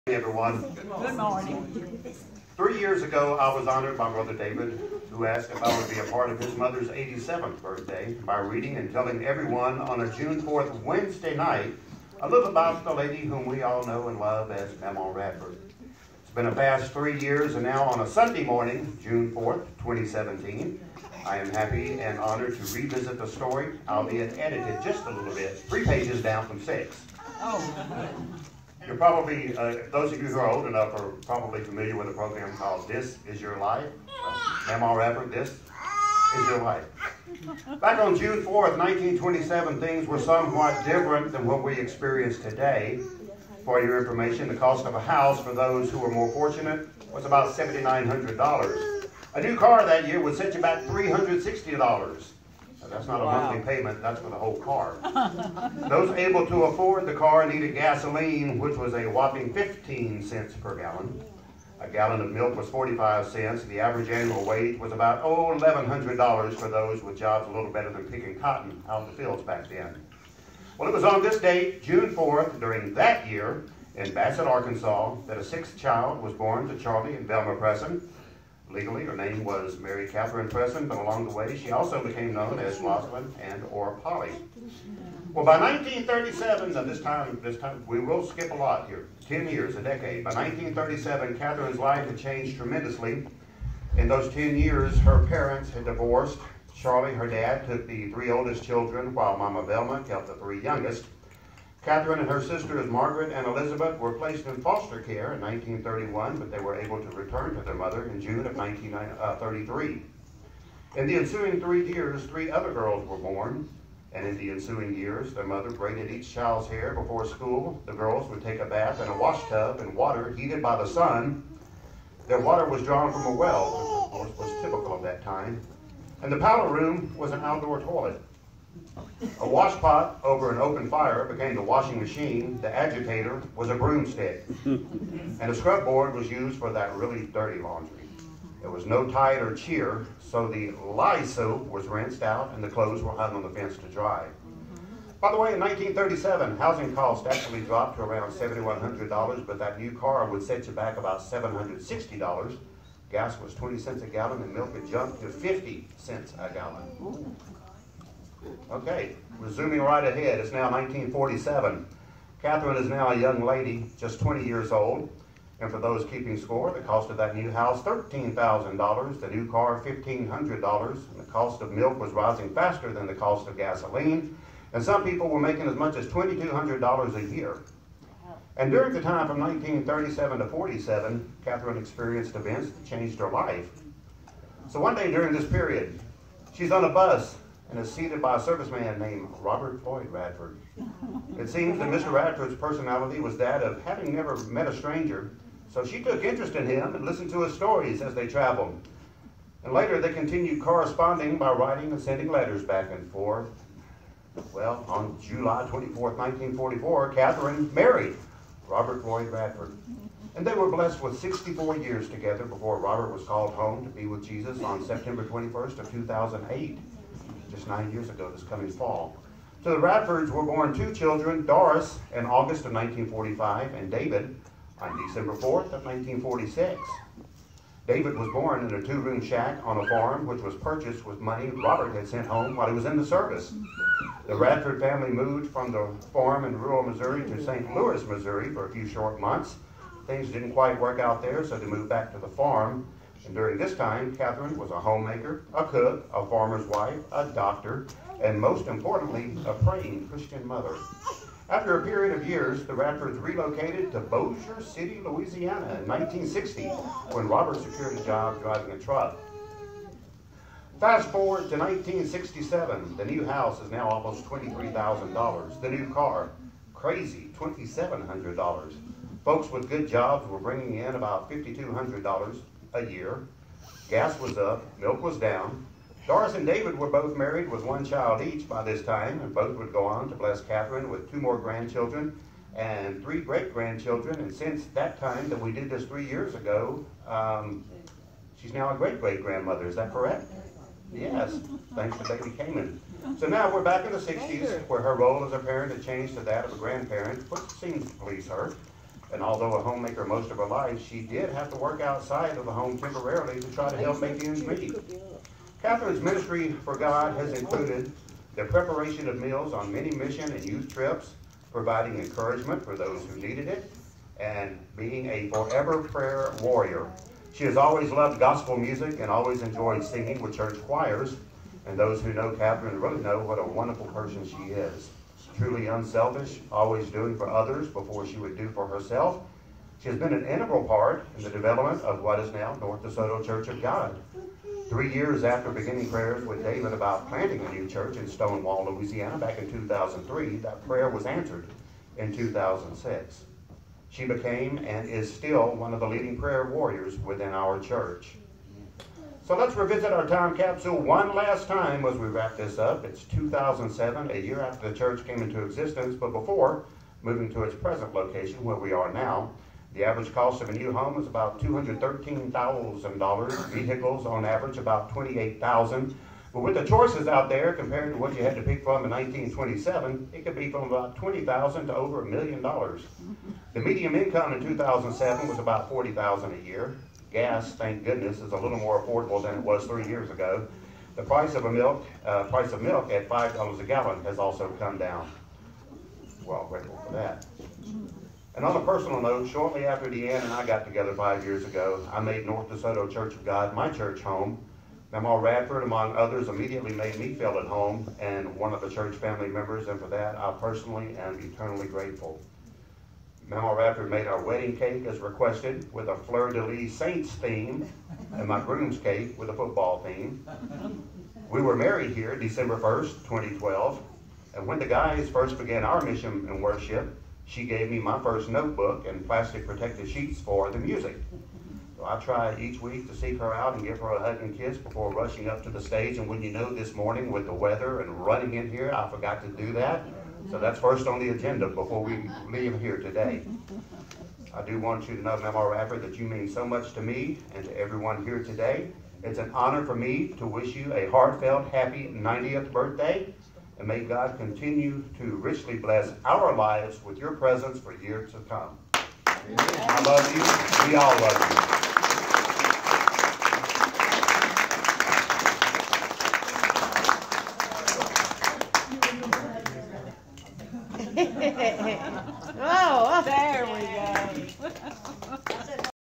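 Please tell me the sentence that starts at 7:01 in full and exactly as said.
So I try each week to seek her out and give her a hug and kiss before rushing up to the stage.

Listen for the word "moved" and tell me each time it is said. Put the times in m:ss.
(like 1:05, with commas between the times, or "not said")
3:55, 4:01.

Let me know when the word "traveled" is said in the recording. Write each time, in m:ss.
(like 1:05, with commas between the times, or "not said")
3:18.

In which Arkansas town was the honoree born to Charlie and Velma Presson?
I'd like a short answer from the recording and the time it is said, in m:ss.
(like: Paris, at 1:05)
Bassett, at 1:14.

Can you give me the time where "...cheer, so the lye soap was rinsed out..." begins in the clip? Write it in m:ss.
2:19.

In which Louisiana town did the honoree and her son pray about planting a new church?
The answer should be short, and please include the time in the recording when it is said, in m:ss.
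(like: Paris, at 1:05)
Stonewall, at 5:38.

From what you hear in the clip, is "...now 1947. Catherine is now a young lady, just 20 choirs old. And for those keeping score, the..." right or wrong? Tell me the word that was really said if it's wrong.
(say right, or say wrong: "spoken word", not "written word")
wrong: "years", not "choirs".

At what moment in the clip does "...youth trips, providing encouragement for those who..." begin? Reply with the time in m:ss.
5:10.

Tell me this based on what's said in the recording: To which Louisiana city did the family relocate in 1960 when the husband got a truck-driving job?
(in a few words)
Bossier City.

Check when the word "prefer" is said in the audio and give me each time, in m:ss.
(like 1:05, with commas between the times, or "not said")
not said.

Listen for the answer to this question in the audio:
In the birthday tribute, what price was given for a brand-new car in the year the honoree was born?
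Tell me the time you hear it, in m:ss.
0:50.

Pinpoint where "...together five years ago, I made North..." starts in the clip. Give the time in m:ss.
6:30.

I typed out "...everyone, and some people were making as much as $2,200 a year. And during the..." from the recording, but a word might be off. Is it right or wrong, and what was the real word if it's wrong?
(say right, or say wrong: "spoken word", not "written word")
wrong: "gasoline", not "everyone".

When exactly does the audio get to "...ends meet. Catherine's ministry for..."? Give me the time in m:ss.
5:04.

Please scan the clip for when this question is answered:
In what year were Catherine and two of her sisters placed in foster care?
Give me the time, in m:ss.
1:45.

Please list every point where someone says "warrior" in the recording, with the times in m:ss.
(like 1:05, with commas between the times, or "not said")
5:16, 5:46.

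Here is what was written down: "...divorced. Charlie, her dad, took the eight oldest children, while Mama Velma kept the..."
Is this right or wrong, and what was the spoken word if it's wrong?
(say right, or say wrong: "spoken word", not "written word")
wrong: "three", not "eight".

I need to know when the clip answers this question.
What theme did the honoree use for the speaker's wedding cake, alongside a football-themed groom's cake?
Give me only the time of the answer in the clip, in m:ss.
6:45.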